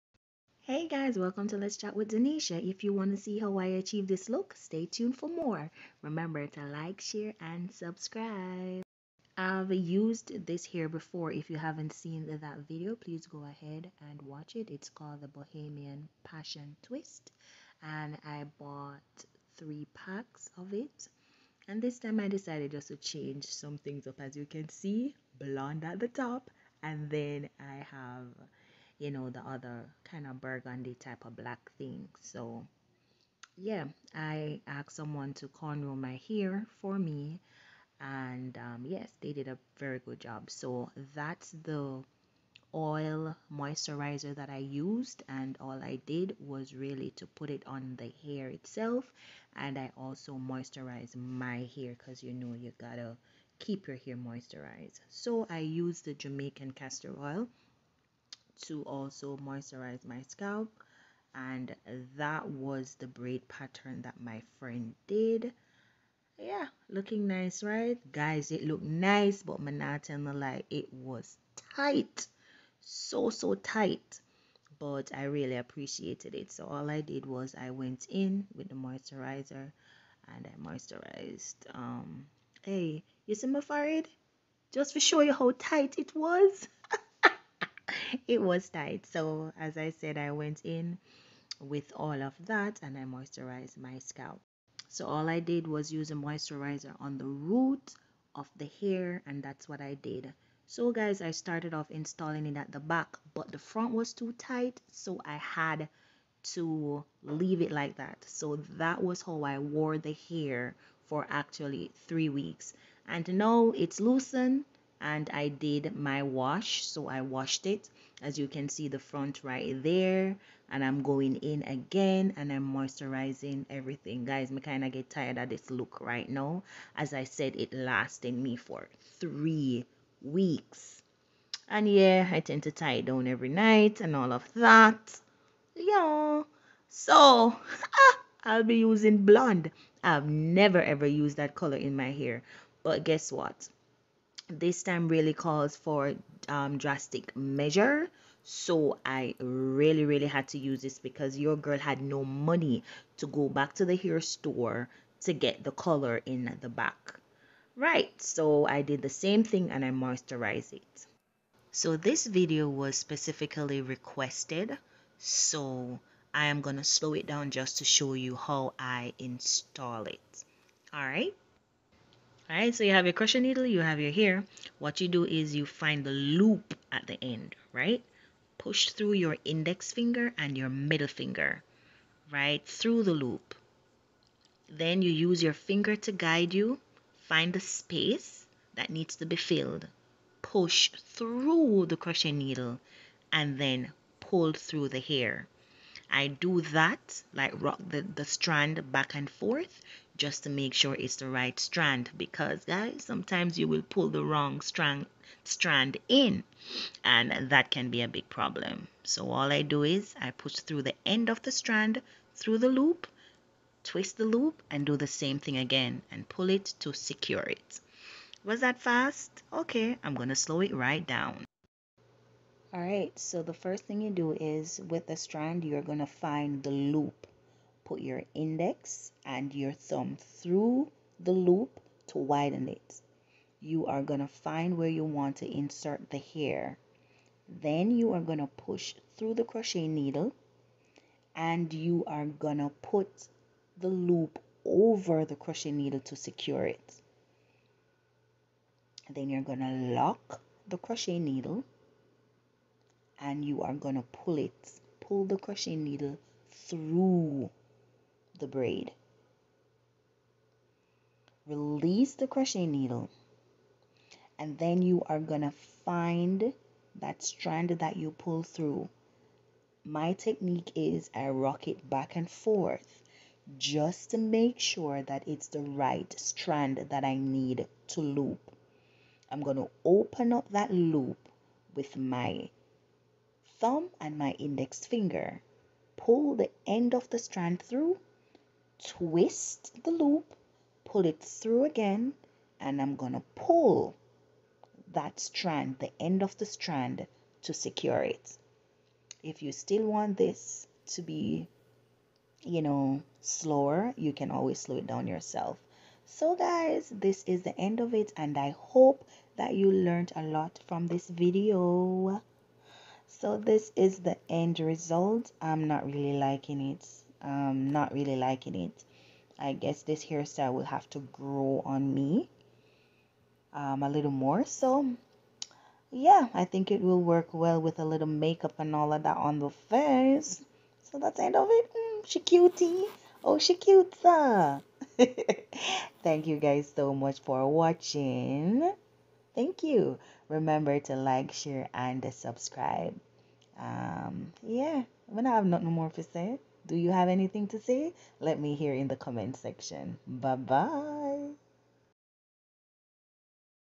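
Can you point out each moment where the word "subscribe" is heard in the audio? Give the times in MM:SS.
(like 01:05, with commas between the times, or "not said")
00:07, 05:42.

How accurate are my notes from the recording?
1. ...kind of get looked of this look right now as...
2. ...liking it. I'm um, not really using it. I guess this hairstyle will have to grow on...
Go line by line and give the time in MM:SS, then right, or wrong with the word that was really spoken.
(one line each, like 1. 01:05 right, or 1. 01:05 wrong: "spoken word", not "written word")
1. 02:04 wrong: "tired", not "looked"
2. 05:16 wrong: "liking", not "using".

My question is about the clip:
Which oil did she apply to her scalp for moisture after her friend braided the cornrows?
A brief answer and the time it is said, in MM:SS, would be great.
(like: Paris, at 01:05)
Jamaican castor oil, at 00:56.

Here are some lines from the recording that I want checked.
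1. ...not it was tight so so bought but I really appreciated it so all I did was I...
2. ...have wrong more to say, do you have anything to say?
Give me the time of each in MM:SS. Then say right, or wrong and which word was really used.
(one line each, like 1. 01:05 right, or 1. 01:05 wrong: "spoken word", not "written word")
1. 01:09 wrong: "tight", not "bought"
2. 05:45 wrong: "nothing", not "wrong".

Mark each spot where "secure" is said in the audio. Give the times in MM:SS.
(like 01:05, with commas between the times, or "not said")
03:36, 04:06, 04:57.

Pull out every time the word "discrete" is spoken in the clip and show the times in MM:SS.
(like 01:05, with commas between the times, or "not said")
not said.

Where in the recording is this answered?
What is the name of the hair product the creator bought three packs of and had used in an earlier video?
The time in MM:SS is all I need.
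00:15.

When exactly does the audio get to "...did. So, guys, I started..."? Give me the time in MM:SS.
01:39.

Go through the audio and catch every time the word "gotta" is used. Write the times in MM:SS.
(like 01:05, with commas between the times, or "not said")
00:52.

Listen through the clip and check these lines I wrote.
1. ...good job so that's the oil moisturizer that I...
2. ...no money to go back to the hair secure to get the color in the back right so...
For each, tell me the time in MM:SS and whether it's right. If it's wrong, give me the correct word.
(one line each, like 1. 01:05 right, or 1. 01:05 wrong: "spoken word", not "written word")
1. 00:39 right
2. 02:32 wrong: "store", not "secure".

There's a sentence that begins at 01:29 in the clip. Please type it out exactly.
So, as I said, I went in with all of that and I moisturized my scalp.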